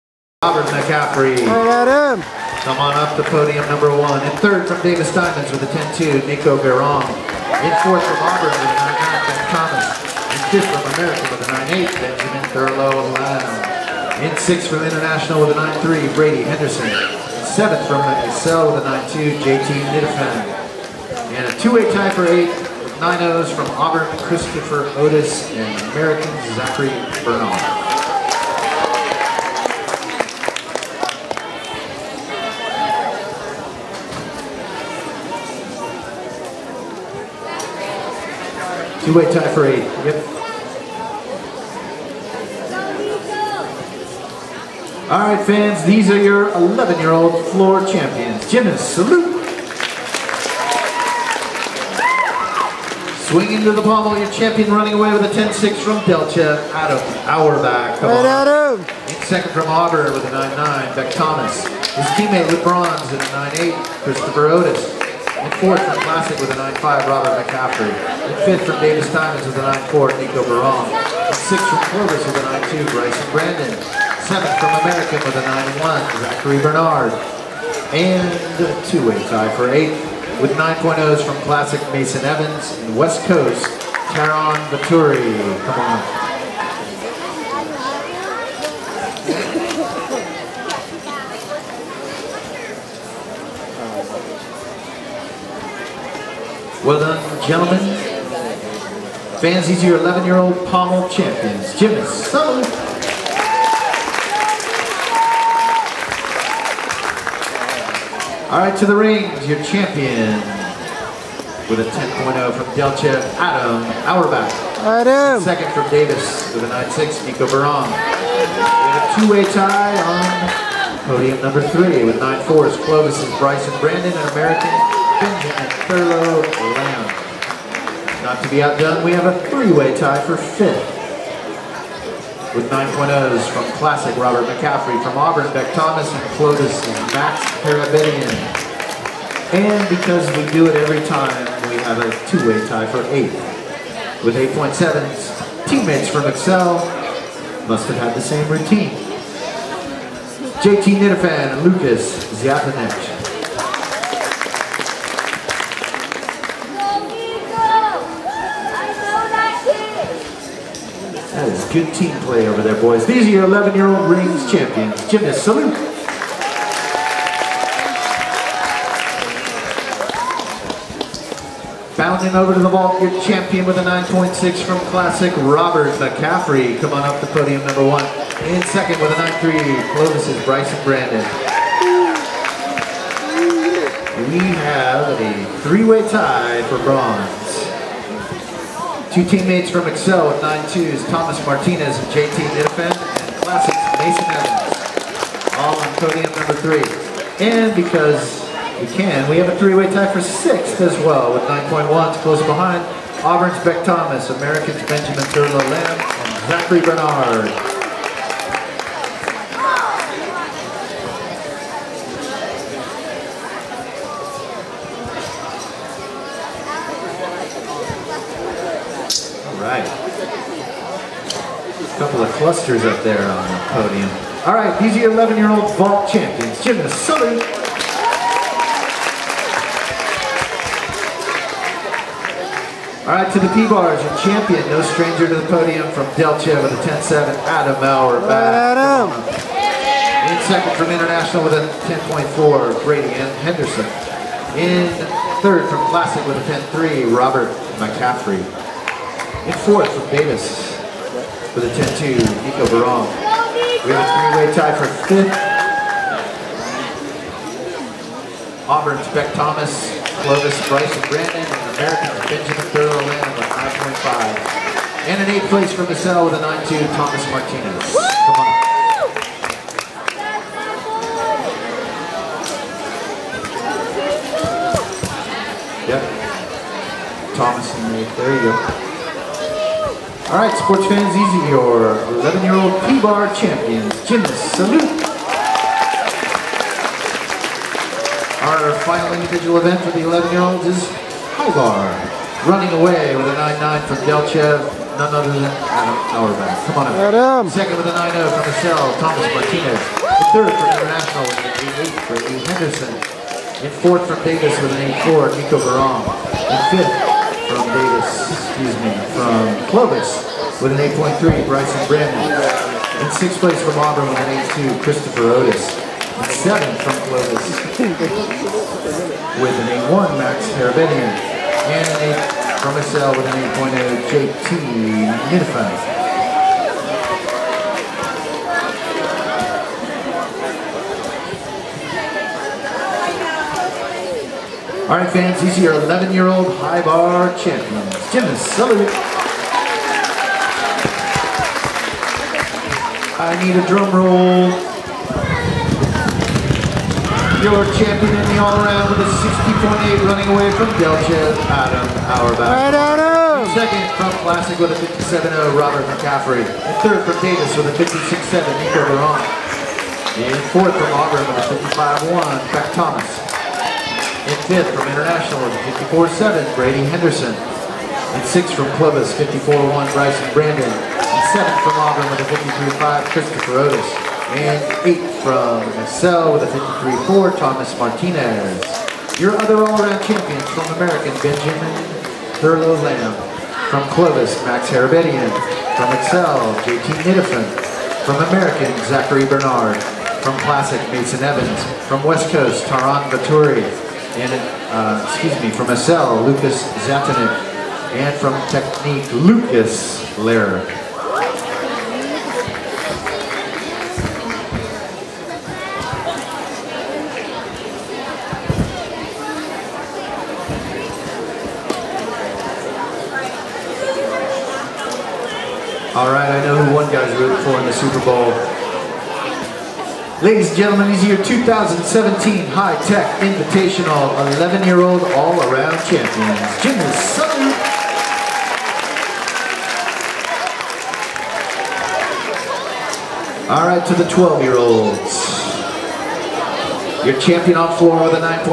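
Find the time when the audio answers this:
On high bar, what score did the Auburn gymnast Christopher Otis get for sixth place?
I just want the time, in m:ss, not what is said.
5:14.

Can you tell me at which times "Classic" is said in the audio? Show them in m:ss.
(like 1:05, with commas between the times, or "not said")
1:06, 1:21, 2:13, 2:54, 3:13, 4:05, 5:54, 6:30.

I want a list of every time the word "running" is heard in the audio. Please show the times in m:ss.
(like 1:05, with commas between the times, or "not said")
0:54, 4:52, 5:50.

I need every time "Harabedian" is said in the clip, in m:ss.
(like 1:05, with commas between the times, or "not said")
6:24.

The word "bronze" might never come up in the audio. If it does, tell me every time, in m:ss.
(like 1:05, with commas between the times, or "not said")
1:02, 3:06.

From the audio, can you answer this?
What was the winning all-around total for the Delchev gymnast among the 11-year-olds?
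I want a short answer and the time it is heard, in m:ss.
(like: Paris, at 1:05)
60.8, at 5:49.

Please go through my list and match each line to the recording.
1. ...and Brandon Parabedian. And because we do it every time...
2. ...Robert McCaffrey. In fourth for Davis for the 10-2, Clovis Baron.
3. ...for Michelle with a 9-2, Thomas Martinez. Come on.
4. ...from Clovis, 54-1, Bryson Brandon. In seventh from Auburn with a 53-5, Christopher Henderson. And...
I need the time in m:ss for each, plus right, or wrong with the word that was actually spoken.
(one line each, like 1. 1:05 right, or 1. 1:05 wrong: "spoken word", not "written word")
1. 2:16 wrong: "Max", not "Brandon"
2. 4:07 wrong: "Nico", not "Clovis"
3. 4:25 right
4. 6:08 wrong: "Otis", not "Henderson".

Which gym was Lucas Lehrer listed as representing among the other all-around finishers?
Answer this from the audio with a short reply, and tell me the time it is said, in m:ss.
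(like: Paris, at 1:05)
Technique, at 6:38.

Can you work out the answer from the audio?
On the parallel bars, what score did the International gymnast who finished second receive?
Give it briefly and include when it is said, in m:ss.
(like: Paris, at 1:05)
10.4, at 4:01.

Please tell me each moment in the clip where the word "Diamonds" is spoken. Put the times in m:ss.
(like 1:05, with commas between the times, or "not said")
0:05, 1:09.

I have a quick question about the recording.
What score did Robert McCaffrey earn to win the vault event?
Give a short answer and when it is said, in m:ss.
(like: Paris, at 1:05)
9.6, at 2:53.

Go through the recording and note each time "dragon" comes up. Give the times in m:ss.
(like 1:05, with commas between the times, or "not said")
not said.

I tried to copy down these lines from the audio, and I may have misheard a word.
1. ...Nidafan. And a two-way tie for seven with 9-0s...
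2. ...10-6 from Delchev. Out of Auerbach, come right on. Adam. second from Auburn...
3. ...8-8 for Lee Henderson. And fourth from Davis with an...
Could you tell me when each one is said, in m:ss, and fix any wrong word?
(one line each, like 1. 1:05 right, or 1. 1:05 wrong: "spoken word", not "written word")
1. 0:19 wrong: "eight", not "seven"
2. 0:55 right
3. 5:01 right.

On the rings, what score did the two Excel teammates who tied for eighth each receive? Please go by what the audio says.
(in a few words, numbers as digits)
8.7.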